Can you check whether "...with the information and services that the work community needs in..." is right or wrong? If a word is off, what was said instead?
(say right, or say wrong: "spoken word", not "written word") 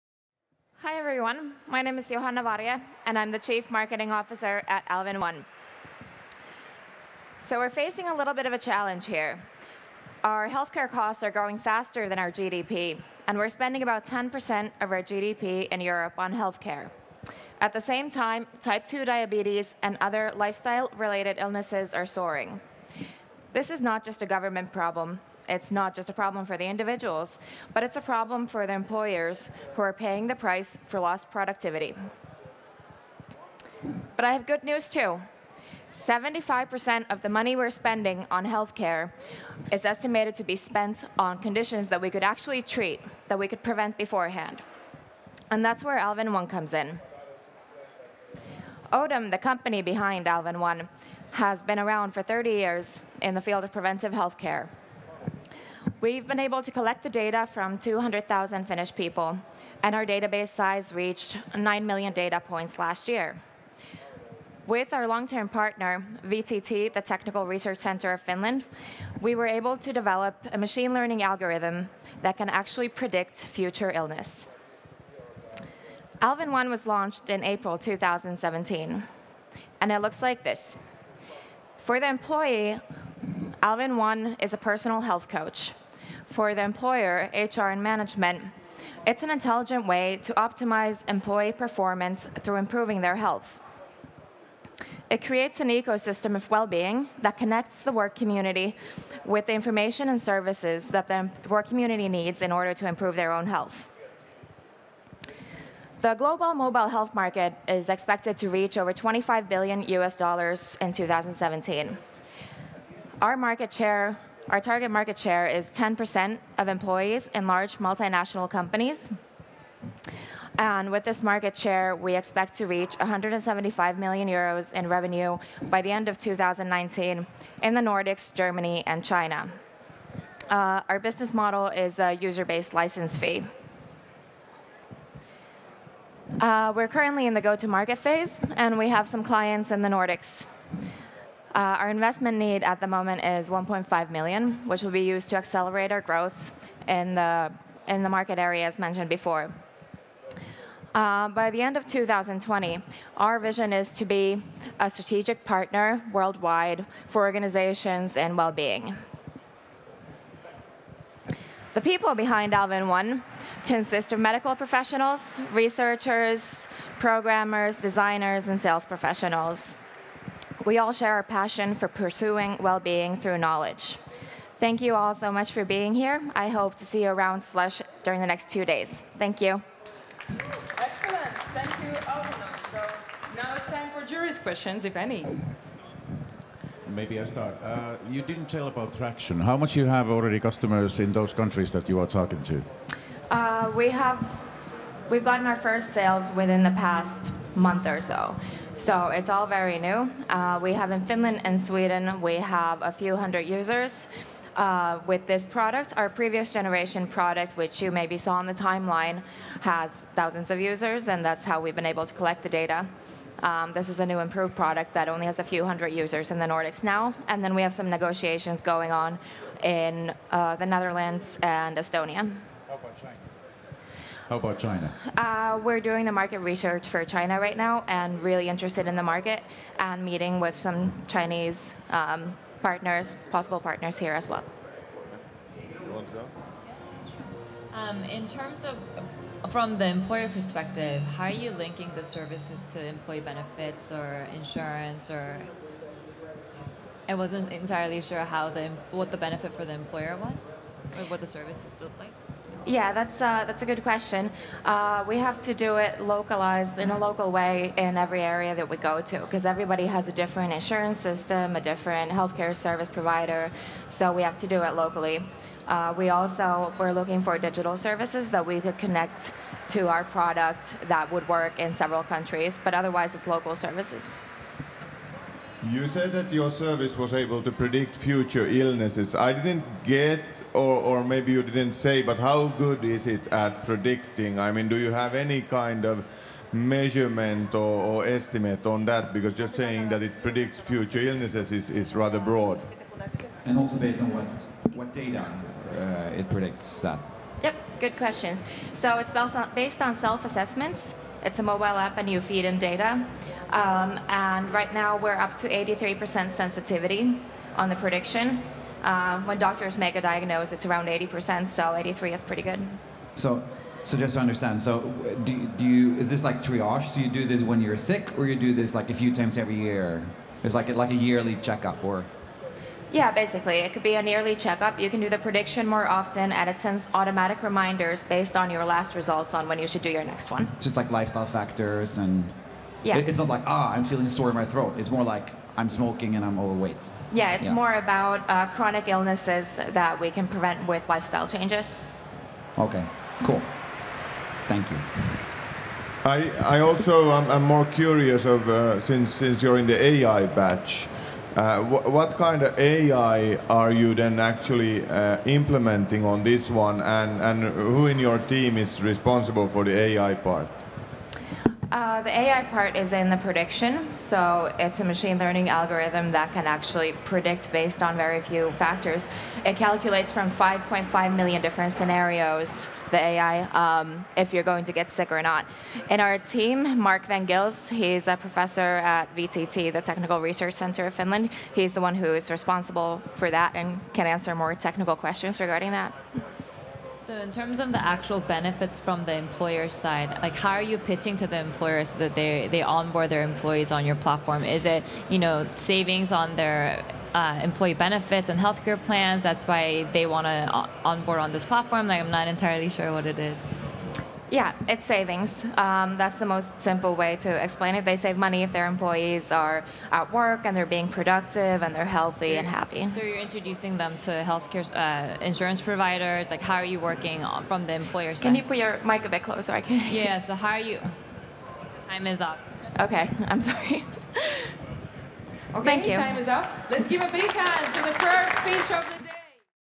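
right.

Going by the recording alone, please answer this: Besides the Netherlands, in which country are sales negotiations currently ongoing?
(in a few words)
Estonia.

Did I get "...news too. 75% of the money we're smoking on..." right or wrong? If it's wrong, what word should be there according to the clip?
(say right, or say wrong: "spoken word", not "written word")
wrong: "spending", not "smoking".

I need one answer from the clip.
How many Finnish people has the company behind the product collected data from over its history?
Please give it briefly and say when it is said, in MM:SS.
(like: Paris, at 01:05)
200,000, at 00:57.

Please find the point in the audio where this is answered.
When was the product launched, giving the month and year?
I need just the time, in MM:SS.
01:17.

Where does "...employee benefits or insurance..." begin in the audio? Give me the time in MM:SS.
04:02.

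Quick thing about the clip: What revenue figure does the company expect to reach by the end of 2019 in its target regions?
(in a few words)
175 million euros.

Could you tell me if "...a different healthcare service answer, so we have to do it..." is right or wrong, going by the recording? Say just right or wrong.
wrong.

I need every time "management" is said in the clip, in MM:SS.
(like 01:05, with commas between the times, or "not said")
01:27.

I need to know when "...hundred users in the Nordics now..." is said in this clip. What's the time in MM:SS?
03:35.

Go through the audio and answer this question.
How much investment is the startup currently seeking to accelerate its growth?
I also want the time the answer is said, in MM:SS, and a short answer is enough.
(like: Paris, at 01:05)
1.5 million, at 02:23.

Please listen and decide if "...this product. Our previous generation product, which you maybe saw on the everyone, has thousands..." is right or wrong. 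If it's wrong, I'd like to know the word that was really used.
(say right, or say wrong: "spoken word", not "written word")
wrong: "timeline", not "everyone".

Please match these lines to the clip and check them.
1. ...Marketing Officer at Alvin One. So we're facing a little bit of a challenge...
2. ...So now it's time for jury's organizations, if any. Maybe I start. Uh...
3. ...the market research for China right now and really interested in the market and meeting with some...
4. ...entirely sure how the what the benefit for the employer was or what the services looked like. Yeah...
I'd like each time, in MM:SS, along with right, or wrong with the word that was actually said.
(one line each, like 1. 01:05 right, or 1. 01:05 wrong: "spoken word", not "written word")
1. 00:03 right
2. 03:02 wrong: "questions", not "organizations"
3. 03:46 right
4. 04:07 right.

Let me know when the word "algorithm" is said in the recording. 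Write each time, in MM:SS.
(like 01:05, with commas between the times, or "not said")
01:11, 06:05.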